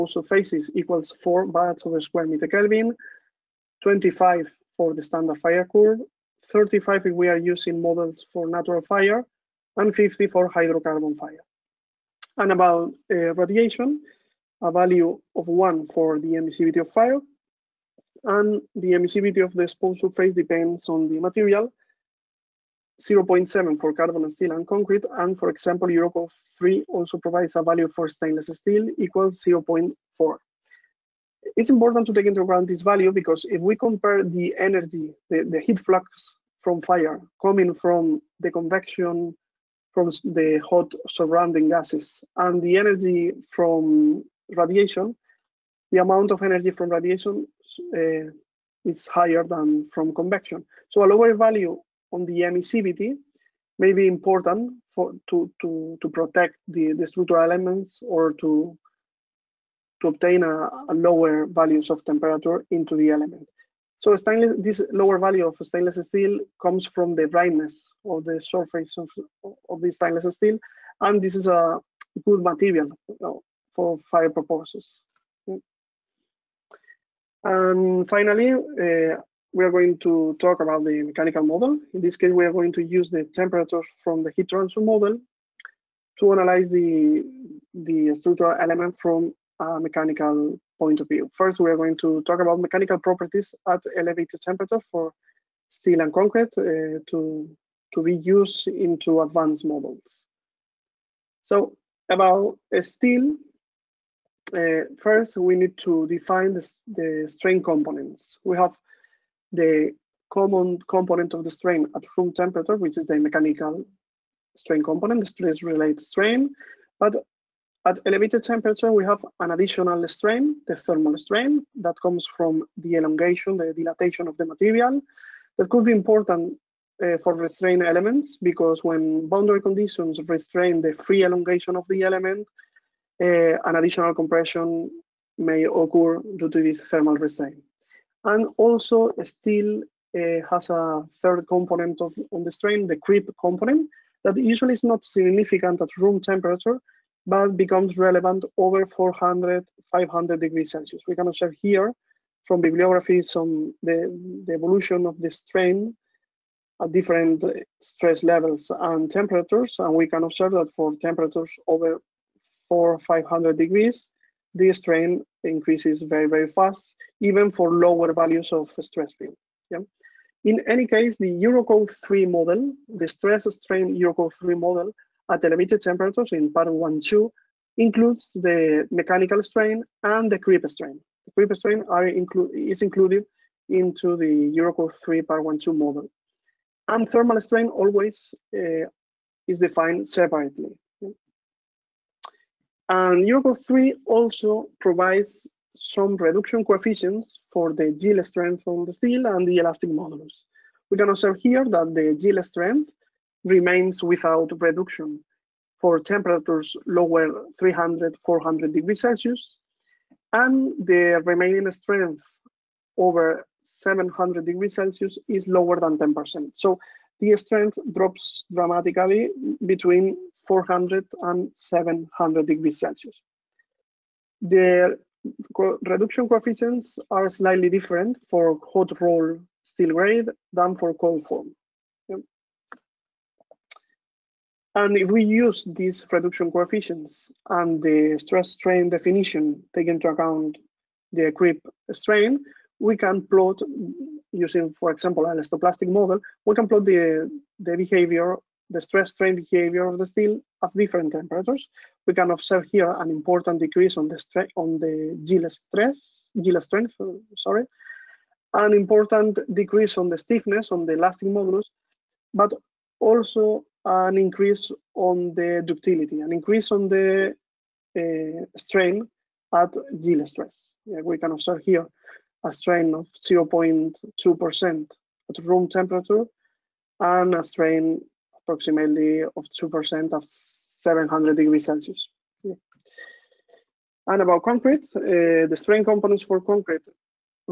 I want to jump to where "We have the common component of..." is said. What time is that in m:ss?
1:48.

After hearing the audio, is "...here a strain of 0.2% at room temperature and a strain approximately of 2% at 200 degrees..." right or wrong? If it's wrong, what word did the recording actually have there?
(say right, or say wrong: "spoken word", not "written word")
wrong: "700", not "200".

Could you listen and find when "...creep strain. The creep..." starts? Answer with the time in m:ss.
3:00.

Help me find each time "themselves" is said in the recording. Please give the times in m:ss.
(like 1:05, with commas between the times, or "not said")
not said.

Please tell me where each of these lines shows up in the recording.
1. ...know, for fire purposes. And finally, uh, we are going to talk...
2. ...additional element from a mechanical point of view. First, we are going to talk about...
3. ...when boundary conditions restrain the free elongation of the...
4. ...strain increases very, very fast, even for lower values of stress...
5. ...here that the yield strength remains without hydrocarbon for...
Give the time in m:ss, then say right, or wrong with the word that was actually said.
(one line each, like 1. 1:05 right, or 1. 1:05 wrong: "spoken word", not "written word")
1. 1:13 right
2. 1:28 wrong: "structural", not "additional"
3. 2:08 right
4. 2:44 right
5. 3:21 wrong: "reduction", not "hydrocarbon".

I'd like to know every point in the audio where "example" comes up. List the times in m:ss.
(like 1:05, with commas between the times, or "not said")
0:25, 4:04.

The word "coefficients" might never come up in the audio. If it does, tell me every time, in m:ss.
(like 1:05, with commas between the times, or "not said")
3:16, 3:46, 3:56.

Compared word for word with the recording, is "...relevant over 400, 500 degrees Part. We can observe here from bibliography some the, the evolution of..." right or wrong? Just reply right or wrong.
wrong.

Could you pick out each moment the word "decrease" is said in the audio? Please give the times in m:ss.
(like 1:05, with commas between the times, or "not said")
4:13, 4:19.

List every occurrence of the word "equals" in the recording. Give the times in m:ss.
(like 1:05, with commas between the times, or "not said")
0:00, 0:28.